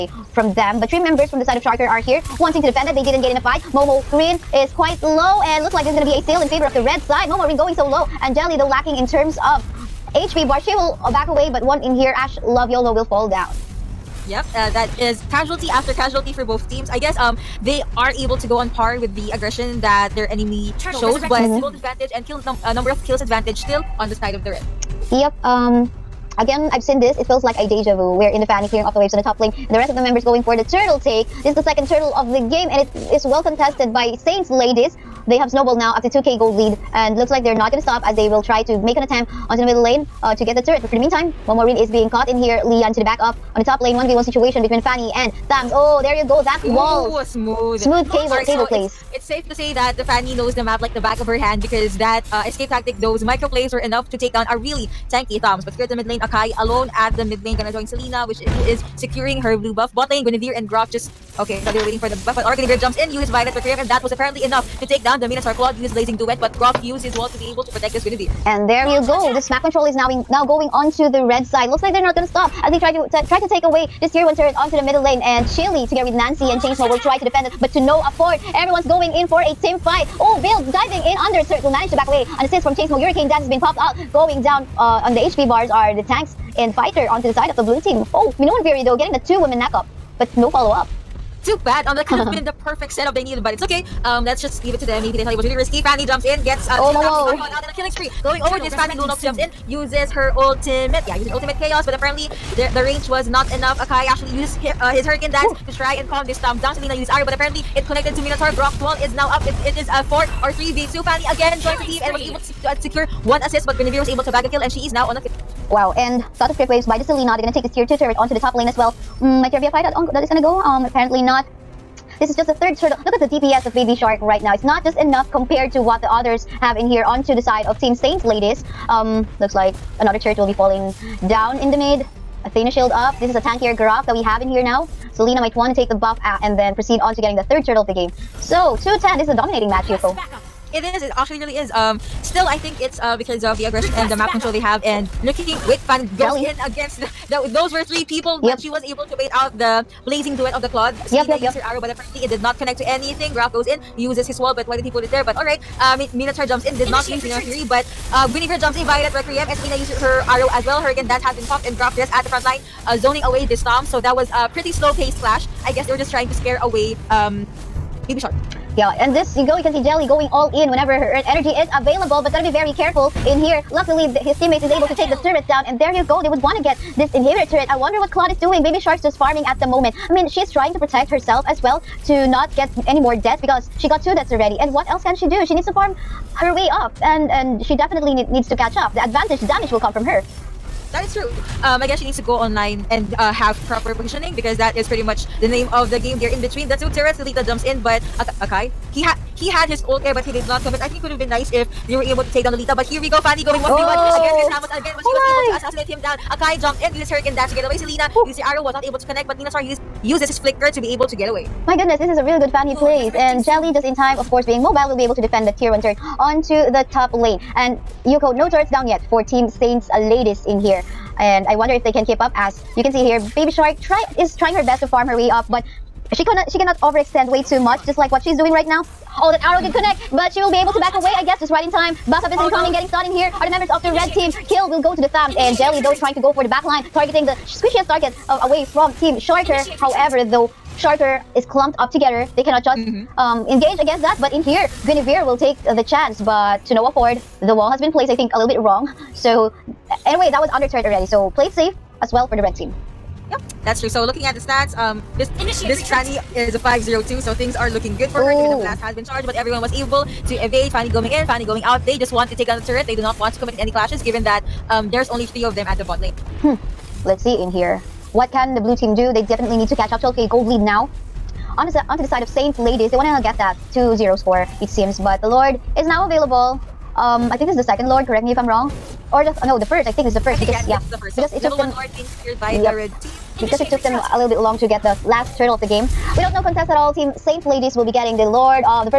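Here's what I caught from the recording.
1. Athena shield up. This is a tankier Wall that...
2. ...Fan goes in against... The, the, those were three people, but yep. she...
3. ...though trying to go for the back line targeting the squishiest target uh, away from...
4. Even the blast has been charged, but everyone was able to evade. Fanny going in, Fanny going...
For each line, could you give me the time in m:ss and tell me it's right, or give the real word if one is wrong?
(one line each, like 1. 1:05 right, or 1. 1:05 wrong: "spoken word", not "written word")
1. 2:12 wrong: "Grok", not "Wall"
2. 2:25 right
3. 3:55 right
4. 4:18 right.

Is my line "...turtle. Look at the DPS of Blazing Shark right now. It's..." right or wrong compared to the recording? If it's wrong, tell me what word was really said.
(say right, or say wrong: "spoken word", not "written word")
wrong: "Baby", not "Blazing".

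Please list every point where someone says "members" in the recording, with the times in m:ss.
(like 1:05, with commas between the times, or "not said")
0:00, 0:30, 3:53.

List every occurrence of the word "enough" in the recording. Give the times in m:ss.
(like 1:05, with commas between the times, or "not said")
0:53, 1:04, 1:43, 2:04.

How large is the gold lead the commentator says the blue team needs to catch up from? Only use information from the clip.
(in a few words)
12k.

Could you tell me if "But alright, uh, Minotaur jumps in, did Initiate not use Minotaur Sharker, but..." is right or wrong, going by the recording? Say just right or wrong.
wrong.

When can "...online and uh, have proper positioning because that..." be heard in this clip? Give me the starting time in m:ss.
3:12.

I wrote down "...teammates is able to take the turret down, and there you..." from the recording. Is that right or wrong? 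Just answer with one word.
right.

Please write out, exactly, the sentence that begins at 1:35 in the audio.
Fanny jumps in, gets uh, oh, no.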